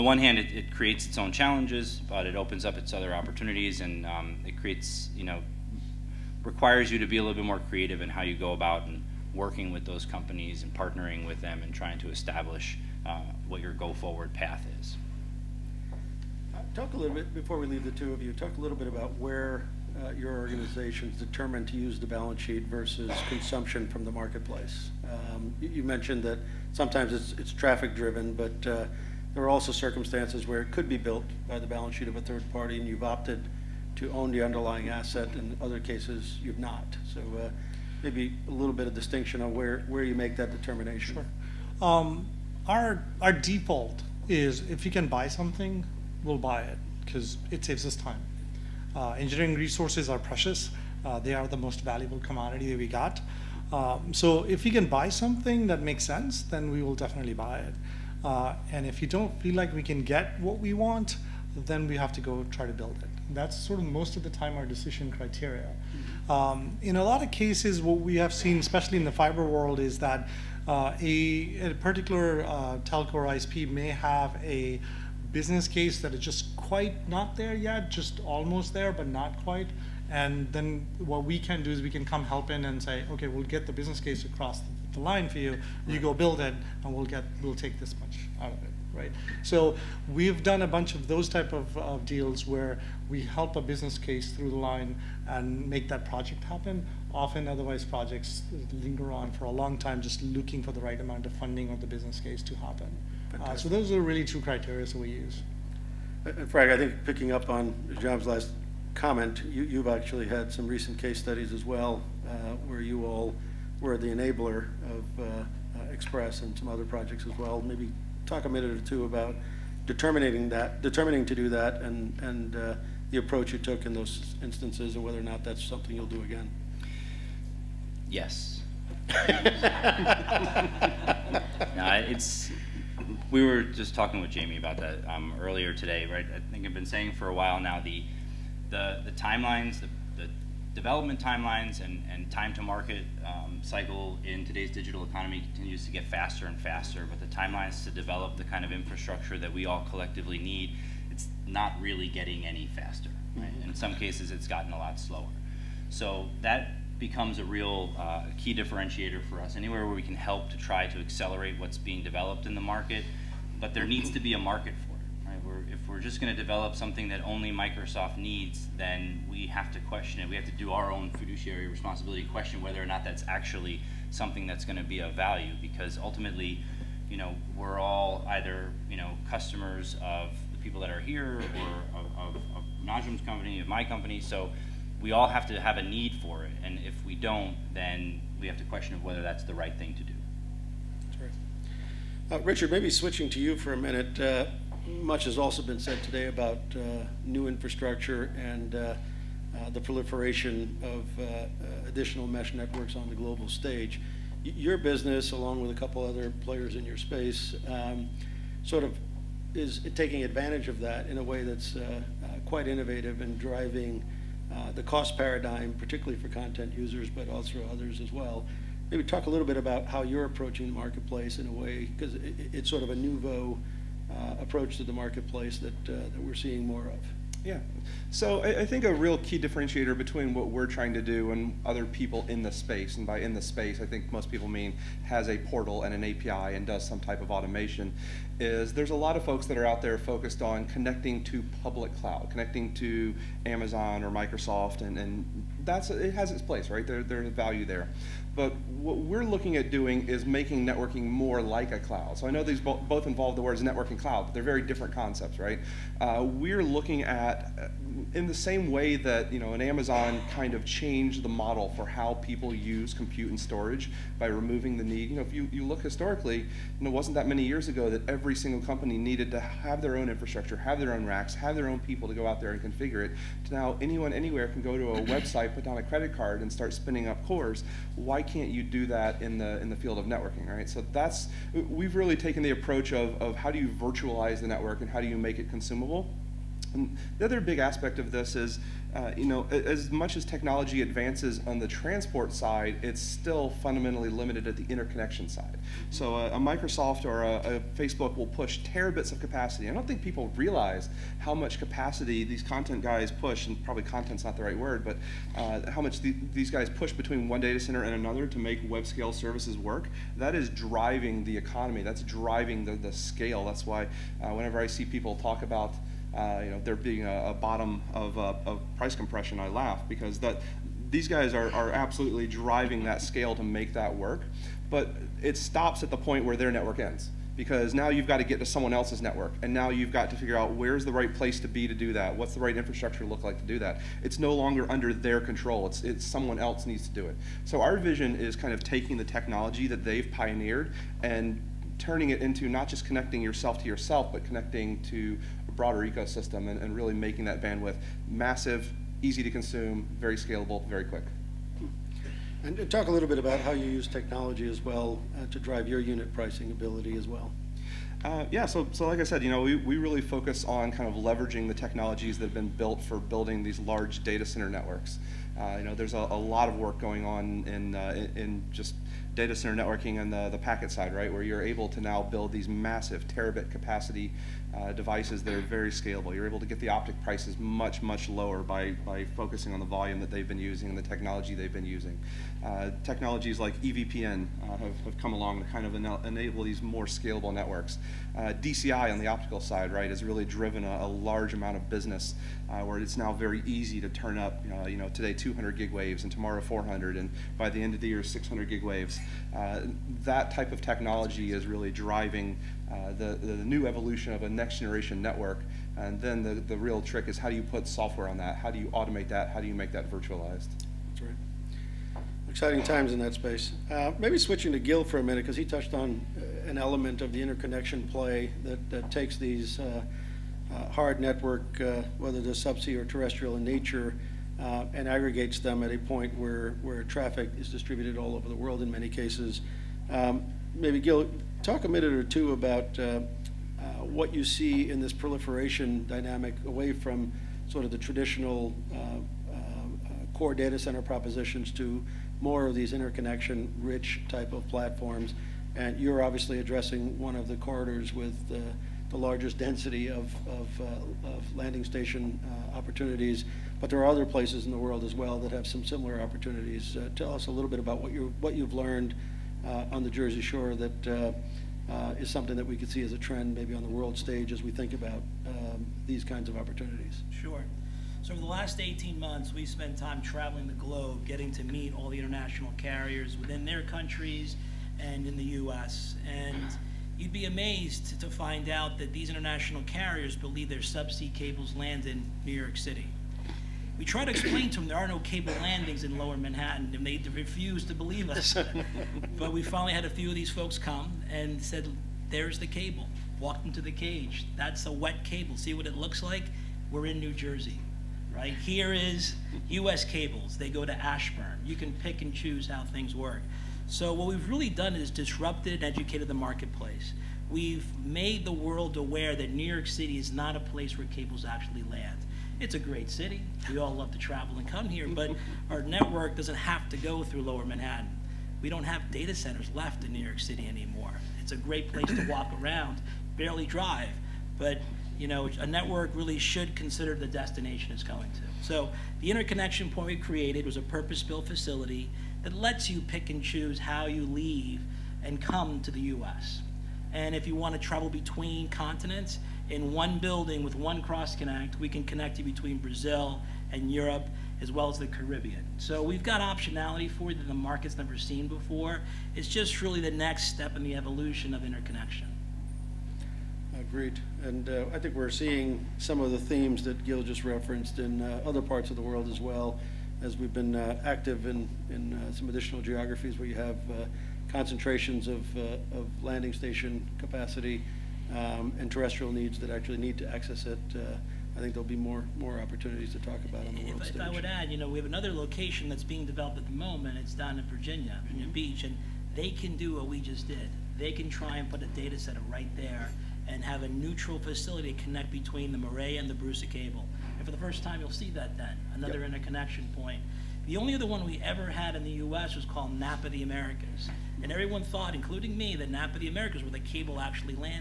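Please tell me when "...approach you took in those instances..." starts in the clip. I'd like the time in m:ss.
2:03.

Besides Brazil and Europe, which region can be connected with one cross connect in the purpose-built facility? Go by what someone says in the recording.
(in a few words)
The Caribbean.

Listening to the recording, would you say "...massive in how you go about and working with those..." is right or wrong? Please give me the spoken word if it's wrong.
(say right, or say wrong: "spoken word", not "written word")
wrong: "creative", not "massive".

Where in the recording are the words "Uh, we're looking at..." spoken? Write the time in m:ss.
4:15.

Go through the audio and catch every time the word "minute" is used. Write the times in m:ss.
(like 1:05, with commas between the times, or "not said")
1:58, 3:13, 6:55, 7:11.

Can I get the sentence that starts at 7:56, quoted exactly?
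And you'd be amazed to find out that these international carriers believe their subsea cables land in New York City.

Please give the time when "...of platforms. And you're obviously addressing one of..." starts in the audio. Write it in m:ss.
7:24.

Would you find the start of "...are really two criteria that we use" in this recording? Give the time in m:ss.
1:43.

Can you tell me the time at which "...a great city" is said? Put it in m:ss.
8:32.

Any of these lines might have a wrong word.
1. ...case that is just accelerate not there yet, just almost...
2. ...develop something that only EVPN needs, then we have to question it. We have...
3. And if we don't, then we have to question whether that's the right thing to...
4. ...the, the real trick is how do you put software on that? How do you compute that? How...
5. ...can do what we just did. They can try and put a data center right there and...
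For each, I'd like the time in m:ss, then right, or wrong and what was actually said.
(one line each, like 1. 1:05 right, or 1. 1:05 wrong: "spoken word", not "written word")
1. 1:15 wrong: "quite", not "accelerate"
2. 2:46 wrong: "Microsoft", not "EVPN"
3. 3:06 right
4. 6:46 wrong: "automate", not "compute"
5. 9:39 right.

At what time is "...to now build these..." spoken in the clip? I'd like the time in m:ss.
6:11.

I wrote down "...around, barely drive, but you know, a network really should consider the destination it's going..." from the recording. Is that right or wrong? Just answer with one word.
right.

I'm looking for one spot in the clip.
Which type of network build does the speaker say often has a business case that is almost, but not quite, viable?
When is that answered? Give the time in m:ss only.
1:09.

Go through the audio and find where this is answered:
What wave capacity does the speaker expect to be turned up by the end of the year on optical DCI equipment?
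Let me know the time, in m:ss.
6:38.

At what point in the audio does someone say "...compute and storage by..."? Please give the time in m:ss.
4:22.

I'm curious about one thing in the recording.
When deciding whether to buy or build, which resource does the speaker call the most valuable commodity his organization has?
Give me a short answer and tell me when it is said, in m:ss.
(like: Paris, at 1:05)
Engineering resources, at 0:49.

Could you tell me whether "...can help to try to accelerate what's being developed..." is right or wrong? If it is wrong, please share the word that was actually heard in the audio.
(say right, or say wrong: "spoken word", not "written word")
right.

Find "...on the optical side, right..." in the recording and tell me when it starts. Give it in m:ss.
6:28.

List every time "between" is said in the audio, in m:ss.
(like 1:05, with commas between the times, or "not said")
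3:49, 5:06, 8:57, 9:02, 9:45.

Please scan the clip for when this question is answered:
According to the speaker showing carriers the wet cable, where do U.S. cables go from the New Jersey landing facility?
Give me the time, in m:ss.
8:20.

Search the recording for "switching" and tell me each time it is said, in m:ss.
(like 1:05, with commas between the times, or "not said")
3:12, 6:54.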